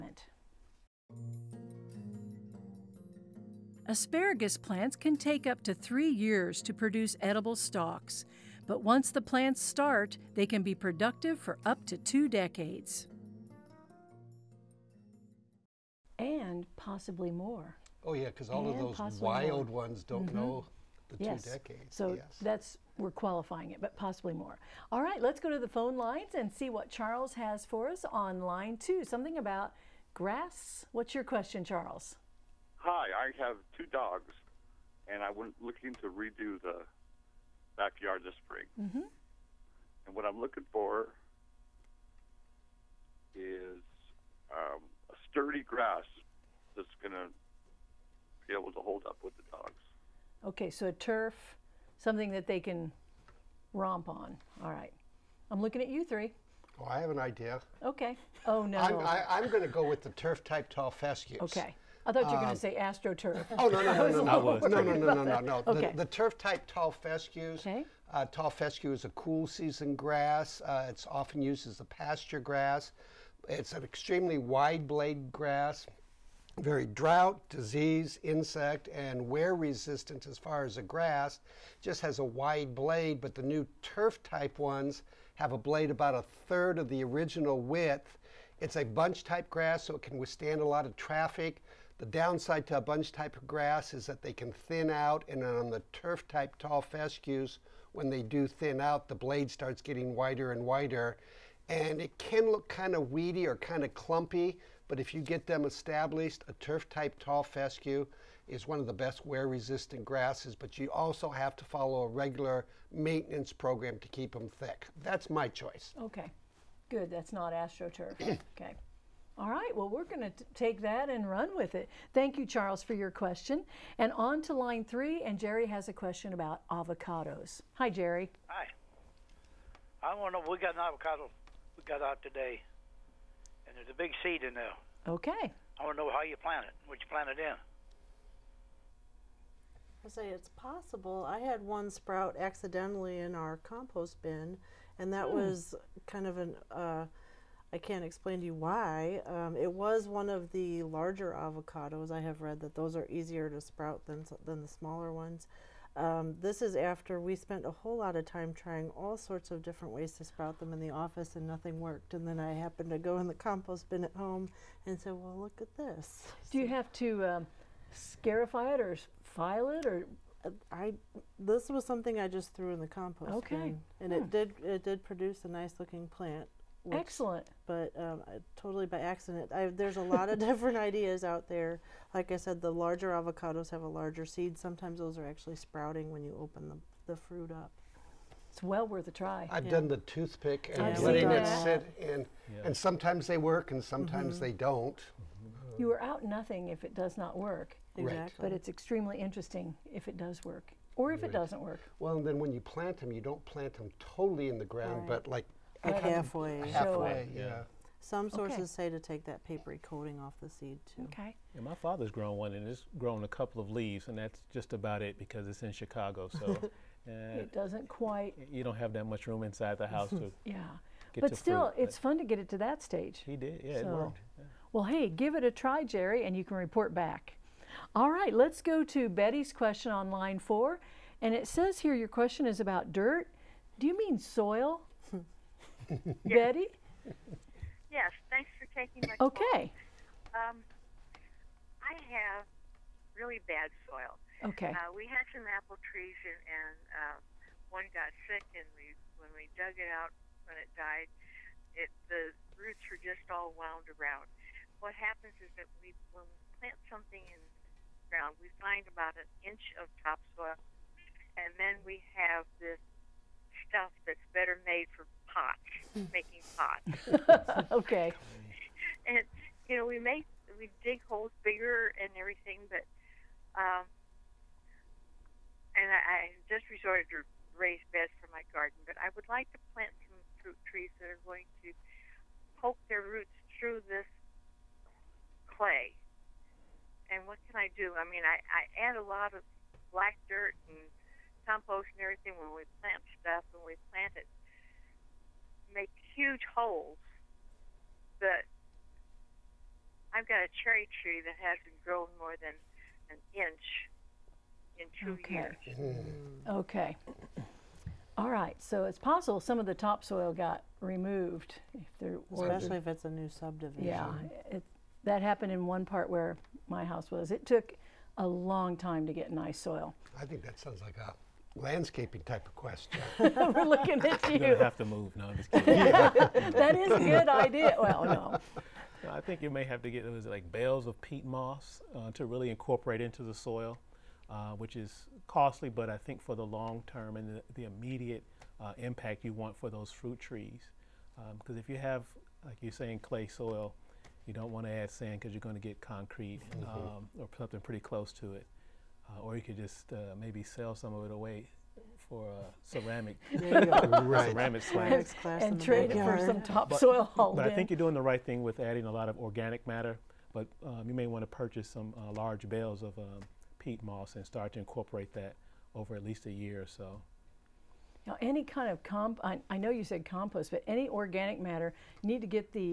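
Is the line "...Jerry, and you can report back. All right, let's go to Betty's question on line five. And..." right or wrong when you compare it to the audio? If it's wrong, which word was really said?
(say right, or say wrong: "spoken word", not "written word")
wrong: "four", not "five".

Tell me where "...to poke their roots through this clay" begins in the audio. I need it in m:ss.
4:41.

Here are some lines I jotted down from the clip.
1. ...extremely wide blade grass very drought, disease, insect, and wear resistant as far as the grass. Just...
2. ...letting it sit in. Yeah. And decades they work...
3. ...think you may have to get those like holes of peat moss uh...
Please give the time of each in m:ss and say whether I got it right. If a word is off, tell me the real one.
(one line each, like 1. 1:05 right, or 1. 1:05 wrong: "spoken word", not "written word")
1. 1:13 right
2. 3:10 wrong: "sometimes", not "decades"
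3. 5:29 wrong: "bales", not "holes".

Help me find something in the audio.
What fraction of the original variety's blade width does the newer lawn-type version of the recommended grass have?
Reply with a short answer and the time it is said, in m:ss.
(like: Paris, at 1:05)
About a third, at 1:26.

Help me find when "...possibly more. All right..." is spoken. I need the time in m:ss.
0:23.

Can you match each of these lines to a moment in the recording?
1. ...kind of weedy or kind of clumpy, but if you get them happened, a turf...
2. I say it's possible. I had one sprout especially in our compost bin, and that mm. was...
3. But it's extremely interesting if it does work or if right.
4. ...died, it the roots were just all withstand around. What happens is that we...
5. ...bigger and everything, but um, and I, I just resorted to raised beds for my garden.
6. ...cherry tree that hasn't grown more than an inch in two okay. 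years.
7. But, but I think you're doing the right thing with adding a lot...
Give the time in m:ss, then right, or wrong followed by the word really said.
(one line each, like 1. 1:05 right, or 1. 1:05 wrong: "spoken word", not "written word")
1. 1:42 wrong: "established", not "happened"
2. 2:20 wrong: "accidentally", not "especially"
3. 3:18 right
4. 4:10 wrong: "wound", not "withstand"
5. 4:31 right
6. 5:00 right
7. 5:57 right.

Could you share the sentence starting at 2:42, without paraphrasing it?
And then I happened to go in the compost bin at home and said, well, look at this.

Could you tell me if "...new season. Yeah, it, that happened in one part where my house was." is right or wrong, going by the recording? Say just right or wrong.
wrong.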